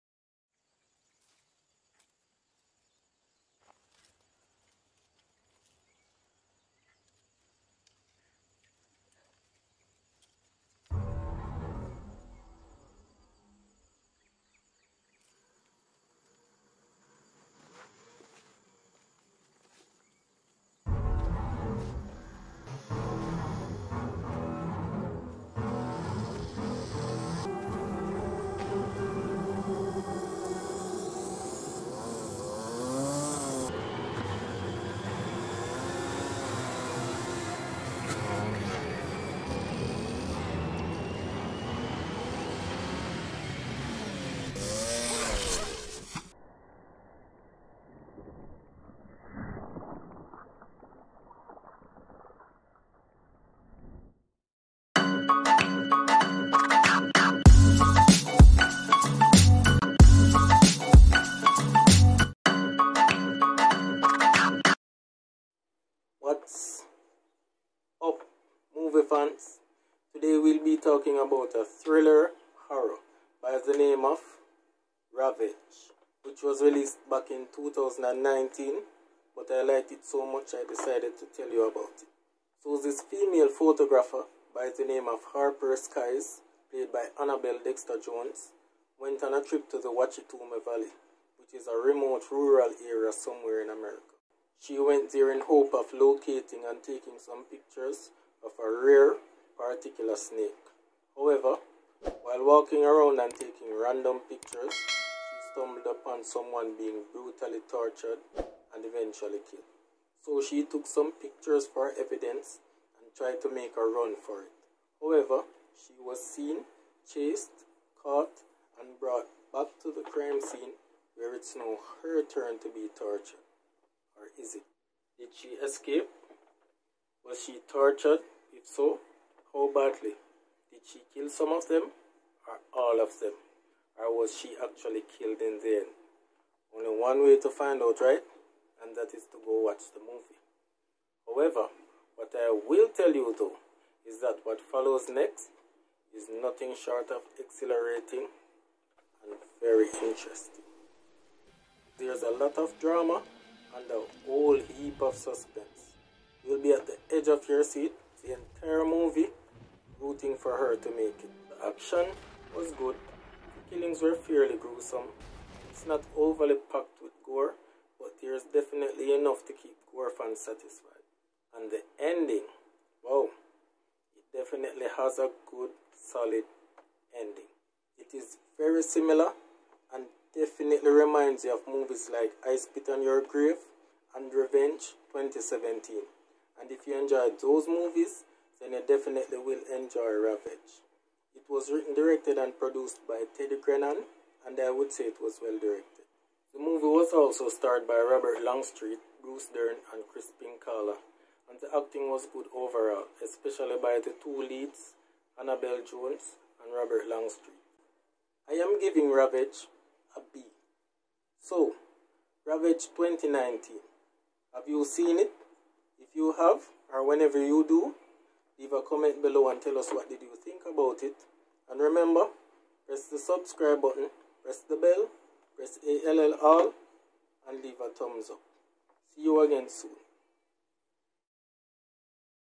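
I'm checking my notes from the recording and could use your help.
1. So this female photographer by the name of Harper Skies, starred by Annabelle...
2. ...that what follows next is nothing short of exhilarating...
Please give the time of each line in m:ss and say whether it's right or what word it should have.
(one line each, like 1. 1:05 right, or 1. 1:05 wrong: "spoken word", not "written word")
1. 1:22 wrong: "played", not "starred"
2. 2:24 right.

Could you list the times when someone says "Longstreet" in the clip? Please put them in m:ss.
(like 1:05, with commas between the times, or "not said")
3:18, 3:27.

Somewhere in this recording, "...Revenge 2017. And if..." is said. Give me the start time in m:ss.
3:04.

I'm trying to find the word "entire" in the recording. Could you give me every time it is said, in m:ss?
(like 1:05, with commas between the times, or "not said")
2:38.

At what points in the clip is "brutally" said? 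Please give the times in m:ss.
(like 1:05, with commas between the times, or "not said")
1:47.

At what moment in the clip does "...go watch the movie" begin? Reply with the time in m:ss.
2:19.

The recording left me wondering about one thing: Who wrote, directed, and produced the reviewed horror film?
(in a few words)
Teddy Grennan.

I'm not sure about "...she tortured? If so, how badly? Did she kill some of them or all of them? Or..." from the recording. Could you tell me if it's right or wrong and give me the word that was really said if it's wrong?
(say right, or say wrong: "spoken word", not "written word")
right.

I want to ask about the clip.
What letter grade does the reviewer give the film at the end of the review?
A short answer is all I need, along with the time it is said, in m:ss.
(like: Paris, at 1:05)
B, at 3:30.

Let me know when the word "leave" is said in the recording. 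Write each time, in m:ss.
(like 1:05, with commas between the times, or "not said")
3:38, 3:47.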